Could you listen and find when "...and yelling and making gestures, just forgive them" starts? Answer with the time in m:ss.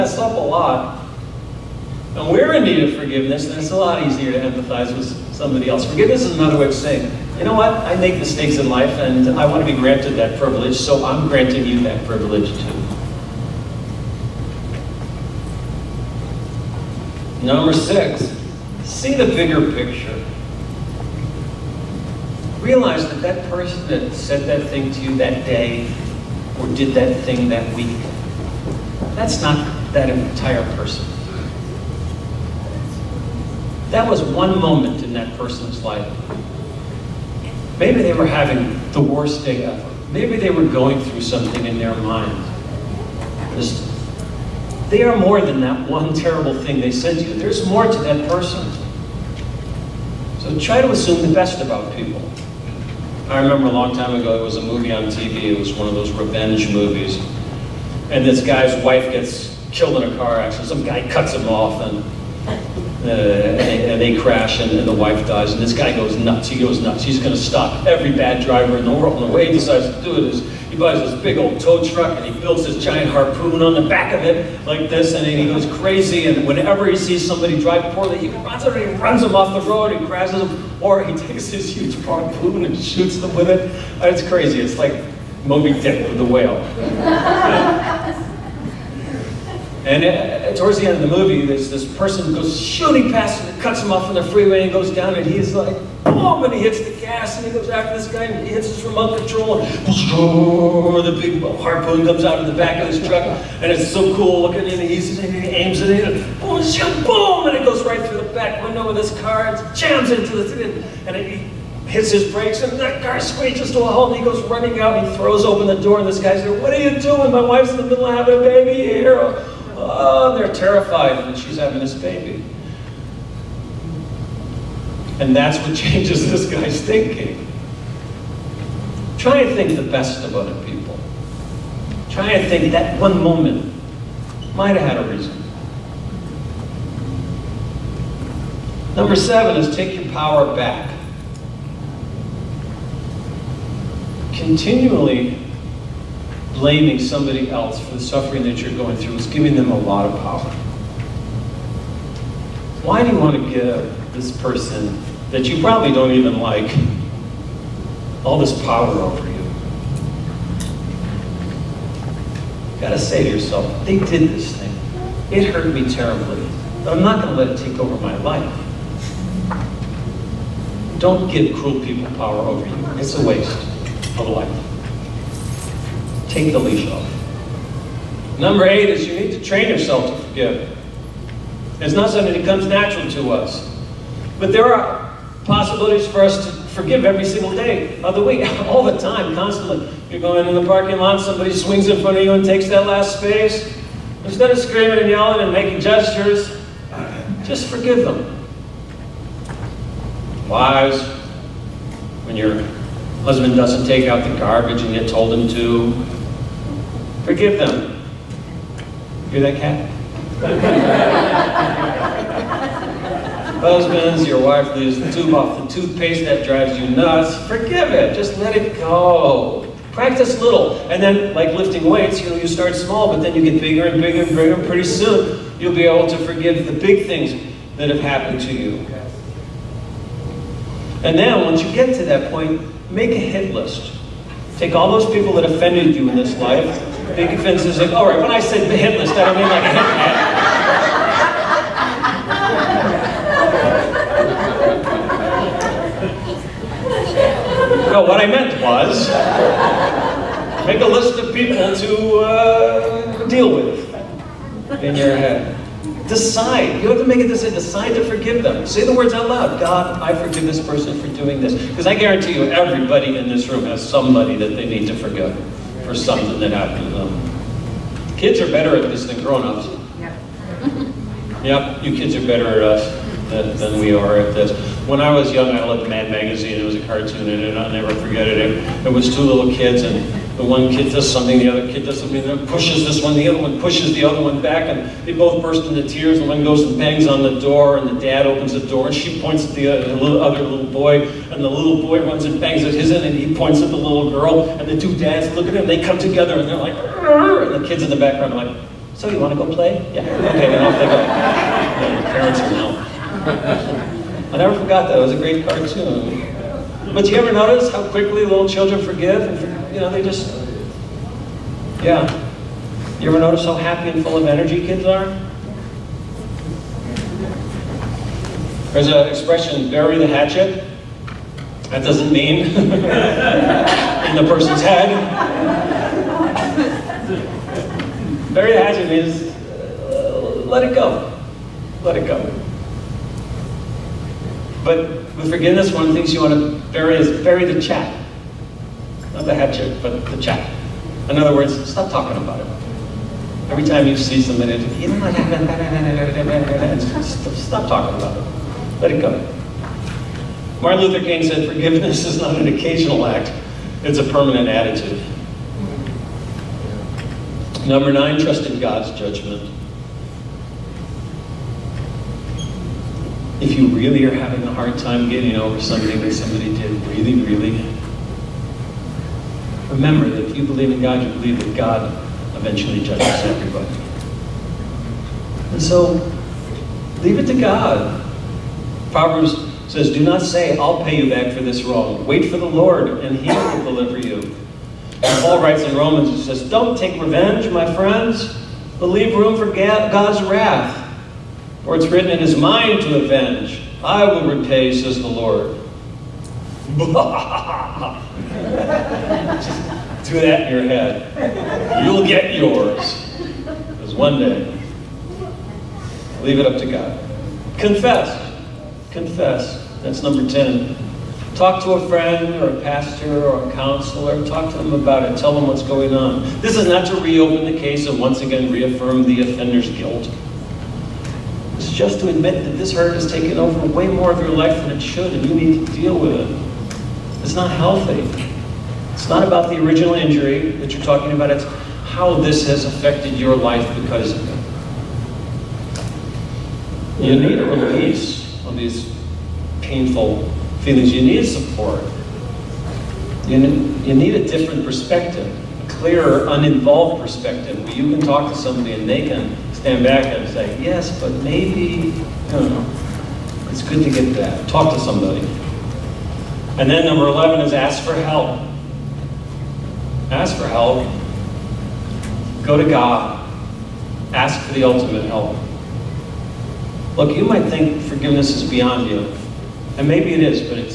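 3:14.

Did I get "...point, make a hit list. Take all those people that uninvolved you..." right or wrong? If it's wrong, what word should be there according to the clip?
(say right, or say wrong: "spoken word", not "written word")
wrong: "offended", not "uninvolved".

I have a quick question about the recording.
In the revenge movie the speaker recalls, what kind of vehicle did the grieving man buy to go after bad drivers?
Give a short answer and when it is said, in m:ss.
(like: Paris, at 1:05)
Tow truck, at 1:11.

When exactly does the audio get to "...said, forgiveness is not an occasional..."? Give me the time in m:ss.
5:51.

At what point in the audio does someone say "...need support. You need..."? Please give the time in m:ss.
7:21.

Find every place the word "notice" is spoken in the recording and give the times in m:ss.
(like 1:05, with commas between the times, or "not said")
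5:07, 5:13.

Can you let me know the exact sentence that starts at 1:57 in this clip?
My wife's in the middle of having a baby here.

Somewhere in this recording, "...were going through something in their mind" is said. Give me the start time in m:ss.
0:40.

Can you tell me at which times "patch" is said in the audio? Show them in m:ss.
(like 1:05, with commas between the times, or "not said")
not said.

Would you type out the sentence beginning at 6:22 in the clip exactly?
Wait for the Lord, and he will deliver you.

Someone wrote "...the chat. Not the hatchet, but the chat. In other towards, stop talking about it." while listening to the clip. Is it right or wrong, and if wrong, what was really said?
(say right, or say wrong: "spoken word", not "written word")
wrong: "words", not "towards".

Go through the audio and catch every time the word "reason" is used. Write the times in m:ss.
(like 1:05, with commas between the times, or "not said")
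2:15.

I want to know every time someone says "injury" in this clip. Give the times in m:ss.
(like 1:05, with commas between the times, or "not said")
7:09.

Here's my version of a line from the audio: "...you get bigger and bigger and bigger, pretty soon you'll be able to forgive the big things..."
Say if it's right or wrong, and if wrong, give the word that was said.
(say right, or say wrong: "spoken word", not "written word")
right.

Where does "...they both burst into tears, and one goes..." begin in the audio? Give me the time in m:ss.
4:45.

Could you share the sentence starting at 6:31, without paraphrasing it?
For it's written, It is mine to avenge.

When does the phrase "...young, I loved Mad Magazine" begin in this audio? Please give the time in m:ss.
4:35.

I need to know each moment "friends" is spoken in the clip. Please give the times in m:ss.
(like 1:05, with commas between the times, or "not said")
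6:27, 6:51.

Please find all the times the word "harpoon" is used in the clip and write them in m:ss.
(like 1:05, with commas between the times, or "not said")
1:13, 1:41.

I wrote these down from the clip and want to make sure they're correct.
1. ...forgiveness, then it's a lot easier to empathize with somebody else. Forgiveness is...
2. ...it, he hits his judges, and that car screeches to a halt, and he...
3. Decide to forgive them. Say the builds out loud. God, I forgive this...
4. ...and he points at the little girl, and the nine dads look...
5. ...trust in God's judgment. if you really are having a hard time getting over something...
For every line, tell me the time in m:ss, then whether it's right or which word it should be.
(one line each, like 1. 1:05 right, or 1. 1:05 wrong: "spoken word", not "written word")
1. 0:02 right
2. 1:51 wrong: "brakes", not "judges"
3. 4:17 wrong: "words", not "builds"
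4. 4:53 wrong: "two", not "nine"
5. 5:58 right.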